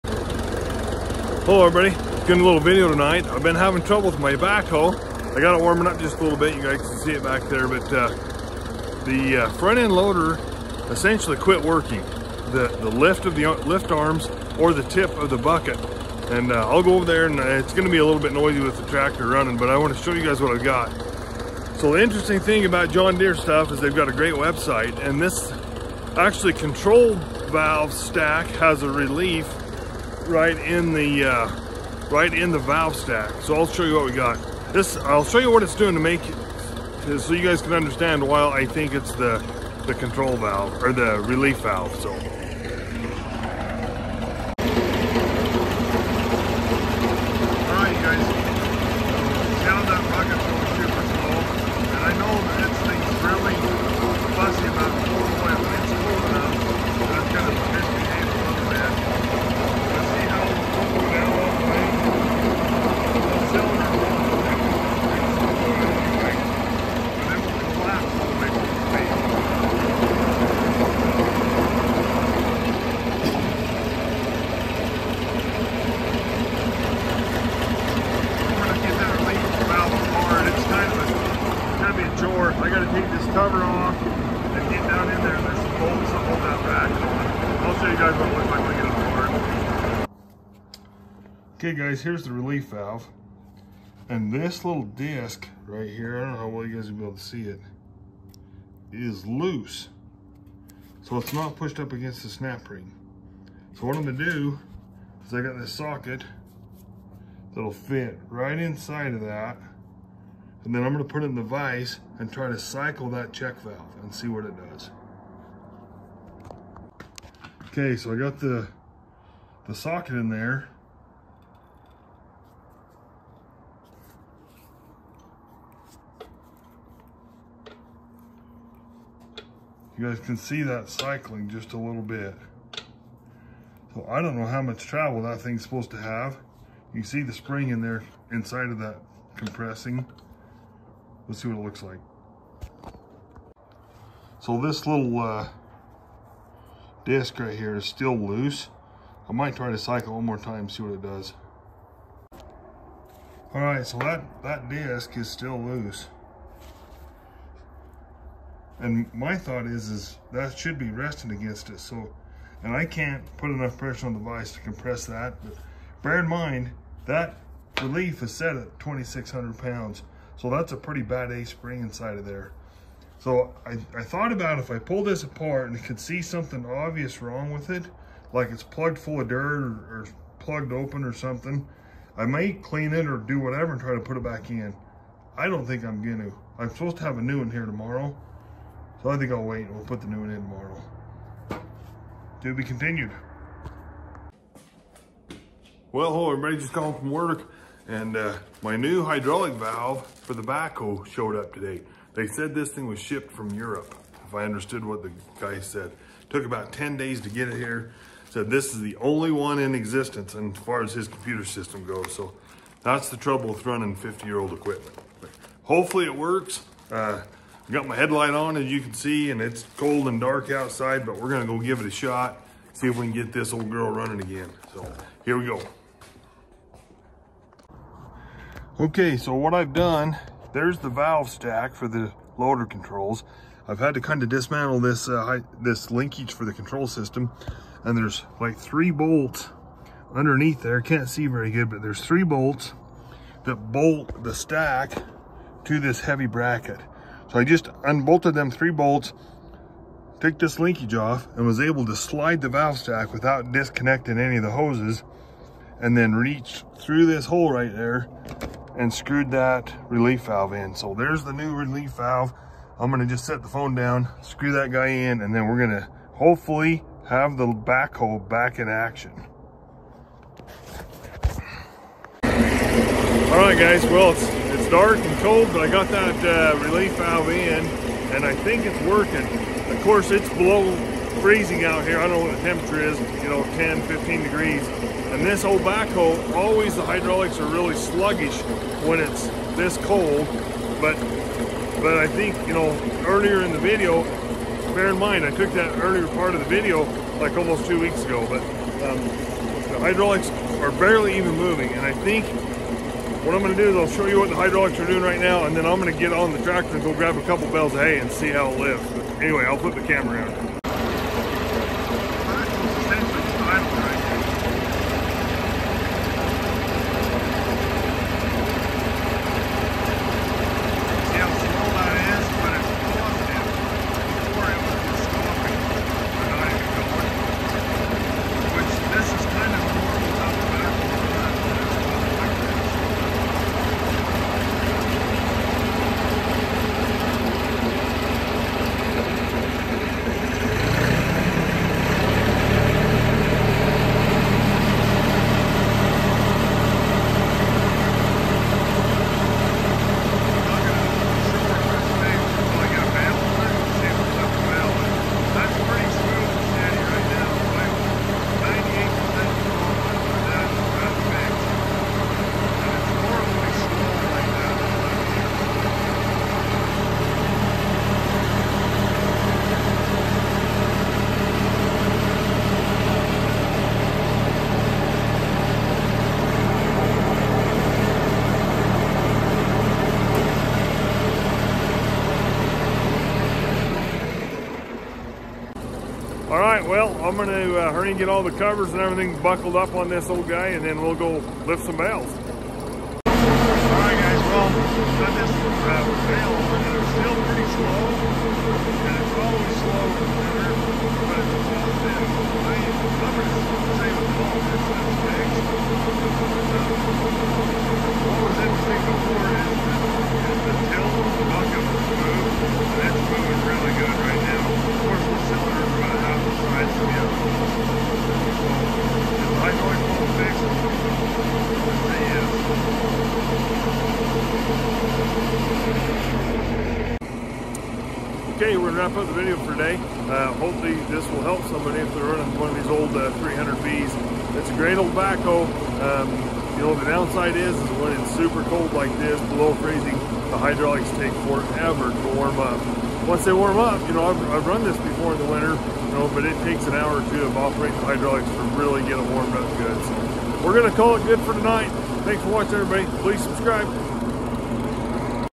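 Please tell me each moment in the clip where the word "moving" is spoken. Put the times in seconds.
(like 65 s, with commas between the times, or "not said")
301 s, 413 s.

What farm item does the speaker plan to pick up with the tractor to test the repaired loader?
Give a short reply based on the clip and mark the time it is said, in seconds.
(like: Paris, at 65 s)
Bales of hay, at 307 s.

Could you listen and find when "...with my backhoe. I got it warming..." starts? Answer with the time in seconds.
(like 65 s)
4 s.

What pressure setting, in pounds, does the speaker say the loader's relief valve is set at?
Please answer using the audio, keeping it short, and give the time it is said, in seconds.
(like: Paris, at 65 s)
2,600 pounds, at 168 s.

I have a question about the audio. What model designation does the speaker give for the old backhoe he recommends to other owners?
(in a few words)
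300B.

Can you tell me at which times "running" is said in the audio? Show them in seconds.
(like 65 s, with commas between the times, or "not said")
19 s, 213 s, 223 s, 432 s.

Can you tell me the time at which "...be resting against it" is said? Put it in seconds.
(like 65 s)
160 s.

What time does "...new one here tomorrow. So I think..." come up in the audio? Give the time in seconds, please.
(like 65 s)
187 s.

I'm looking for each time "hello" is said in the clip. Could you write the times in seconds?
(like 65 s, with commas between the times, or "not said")
1 s, 196 s.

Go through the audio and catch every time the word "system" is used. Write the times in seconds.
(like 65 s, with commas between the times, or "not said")
211 s, 236 s.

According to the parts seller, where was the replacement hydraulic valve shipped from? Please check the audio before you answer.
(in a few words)
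Europe.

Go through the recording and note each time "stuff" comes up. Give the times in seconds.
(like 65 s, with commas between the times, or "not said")
23 s.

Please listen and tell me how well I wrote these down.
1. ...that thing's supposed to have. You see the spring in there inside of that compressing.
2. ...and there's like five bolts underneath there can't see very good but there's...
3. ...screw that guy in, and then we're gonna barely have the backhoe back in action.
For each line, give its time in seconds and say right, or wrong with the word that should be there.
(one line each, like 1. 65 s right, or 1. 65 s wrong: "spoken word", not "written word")
1. 135 s right
2. 237 s wrong: "three", not "five"
3. 264 s wrong: "hopefully", not "barely".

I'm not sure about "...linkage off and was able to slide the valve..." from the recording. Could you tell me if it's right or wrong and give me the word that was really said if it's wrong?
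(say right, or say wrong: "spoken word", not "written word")
right.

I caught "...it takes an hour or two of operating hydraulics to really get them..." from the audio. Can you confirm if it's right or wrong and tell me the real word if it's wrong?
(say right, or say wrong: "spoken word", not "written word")
right.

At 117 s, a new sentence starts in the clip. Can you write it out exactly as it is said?
Okay, so I got the, the socket in there You guys can see that cycling just a little bit.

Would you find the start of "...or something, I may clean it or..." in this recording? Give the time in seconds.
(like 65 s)
181 s.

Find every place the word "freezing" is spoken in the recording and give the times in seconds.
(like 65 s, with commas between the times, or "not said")
281 s, 439 s.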